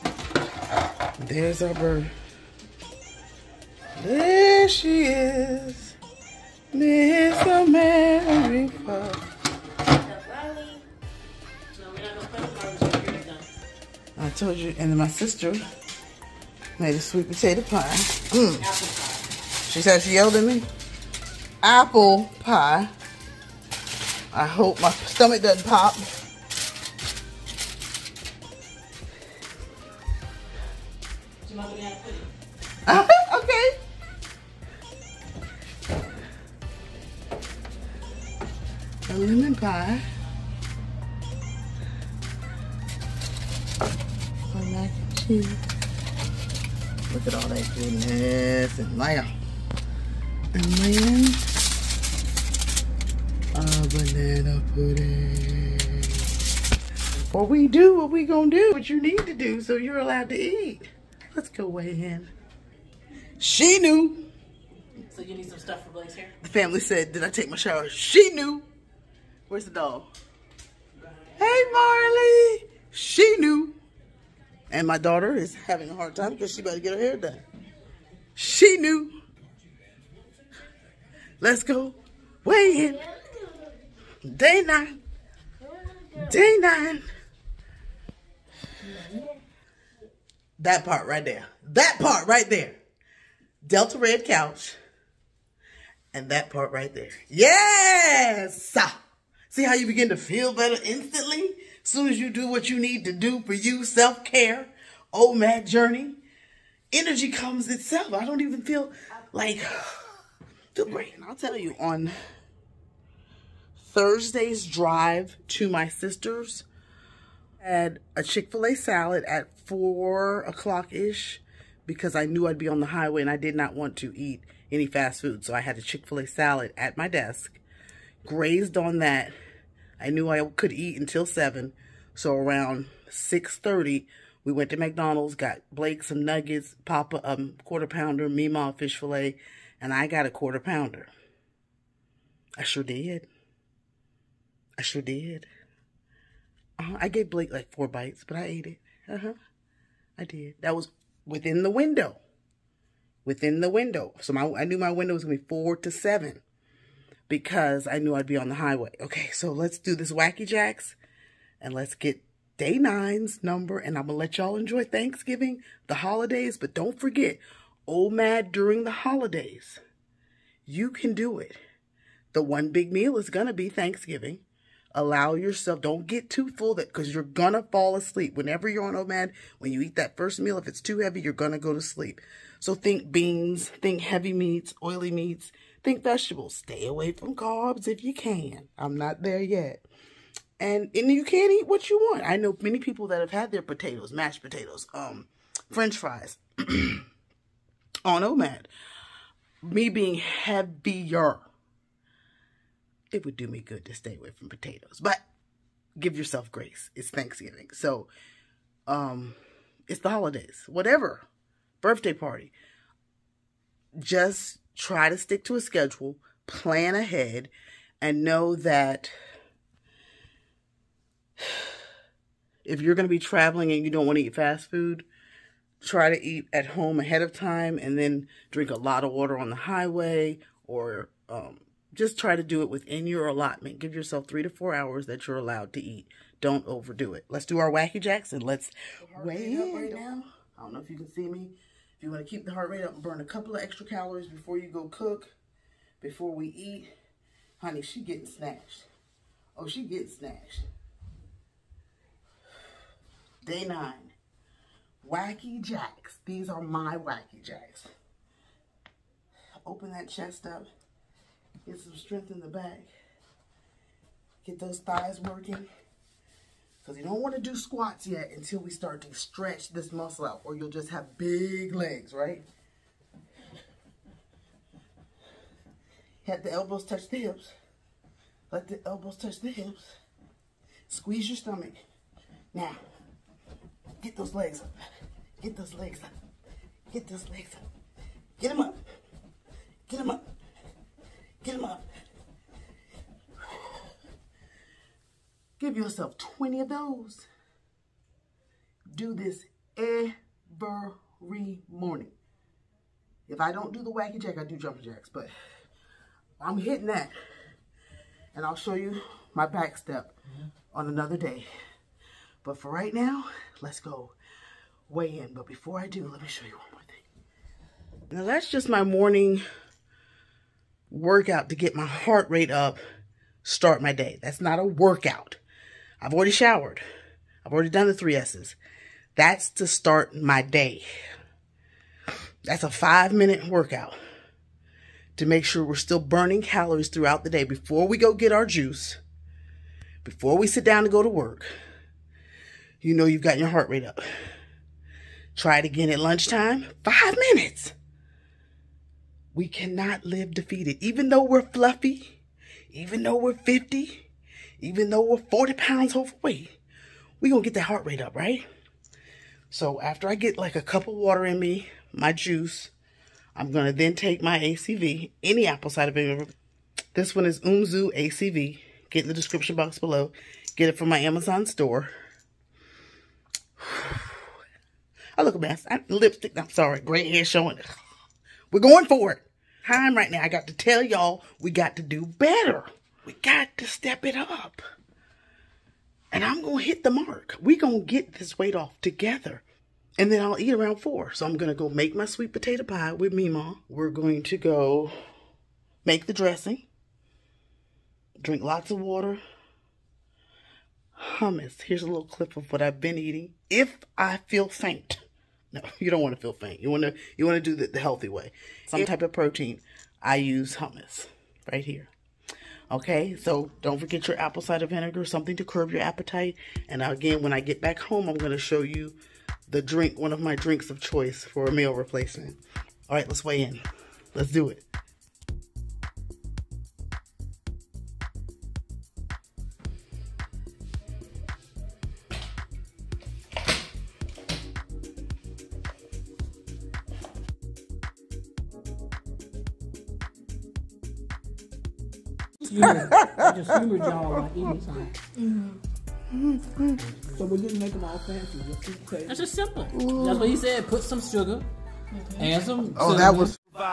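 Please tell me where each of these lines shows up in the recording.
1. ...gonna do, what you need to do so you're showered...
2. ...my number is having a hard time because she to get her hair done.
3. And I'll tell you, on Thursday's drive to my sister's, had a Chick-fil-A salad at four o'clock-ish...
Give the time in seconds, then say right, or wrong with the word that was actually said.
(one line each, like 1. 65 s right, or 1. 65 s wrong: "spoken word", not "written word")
1. 58 s wrong: "allowed", not "showered"
2. 74 s wrong: "daughter", not "number"
3. 111 s right.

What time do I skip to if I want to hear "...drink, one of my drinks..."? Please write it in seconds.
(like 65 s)
419 s.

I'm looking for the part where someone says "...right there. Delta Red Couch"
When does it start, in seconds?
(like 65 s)
92 s.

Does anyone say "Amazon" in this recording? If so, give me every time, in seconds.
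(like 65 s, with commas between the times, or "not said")
370 s.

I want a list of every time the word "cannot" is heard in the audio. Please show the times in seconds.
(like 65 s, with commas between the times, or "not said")
349 s.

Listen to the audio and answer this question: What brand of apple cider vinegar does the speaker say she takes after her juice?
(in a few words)
Umzu.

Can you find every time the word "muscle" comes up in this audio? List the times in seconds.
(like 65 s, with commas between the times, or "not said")
269 s.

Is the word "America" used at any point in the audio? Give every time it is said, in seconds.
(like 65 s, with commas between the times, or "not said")
7 s.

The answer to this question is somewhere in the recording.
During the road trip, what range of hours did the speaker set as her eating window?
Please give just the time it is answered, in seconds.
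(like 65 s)
155 s.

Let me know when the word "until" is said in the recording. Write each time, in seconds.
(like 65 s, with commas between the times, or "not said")
130 s, 268 s.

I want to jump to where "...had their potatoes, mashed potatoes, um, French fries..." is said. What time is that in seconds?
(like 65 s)
193 s.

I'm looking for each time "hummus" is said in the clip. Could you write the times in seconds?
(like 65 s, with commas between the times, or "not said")
401 s, 410 s.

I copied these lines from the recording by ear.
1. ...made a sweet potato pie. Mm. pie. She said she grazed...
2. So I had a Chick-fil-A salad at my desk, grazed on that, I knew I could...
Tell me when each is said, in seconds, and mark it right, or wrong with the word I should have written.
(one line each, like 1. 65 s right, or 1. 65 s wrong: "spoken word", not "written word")
1. 16 s wrong: "yelled", not "grazed"
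2. 125 s right.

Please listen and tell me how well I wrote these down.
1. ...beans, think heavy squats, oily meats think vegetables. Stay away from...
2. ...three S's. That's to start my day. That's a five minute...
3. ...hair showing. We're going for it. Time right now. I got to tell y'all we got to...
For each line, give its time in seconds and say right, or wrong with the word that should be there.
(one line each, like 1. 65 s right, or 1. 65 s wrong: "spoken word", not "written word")
1. 183 s wrong: "meats", not "squats"
2. 327 s right
3. 377 s right.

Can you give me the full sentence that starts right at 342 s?
You know you've got your heart rate up.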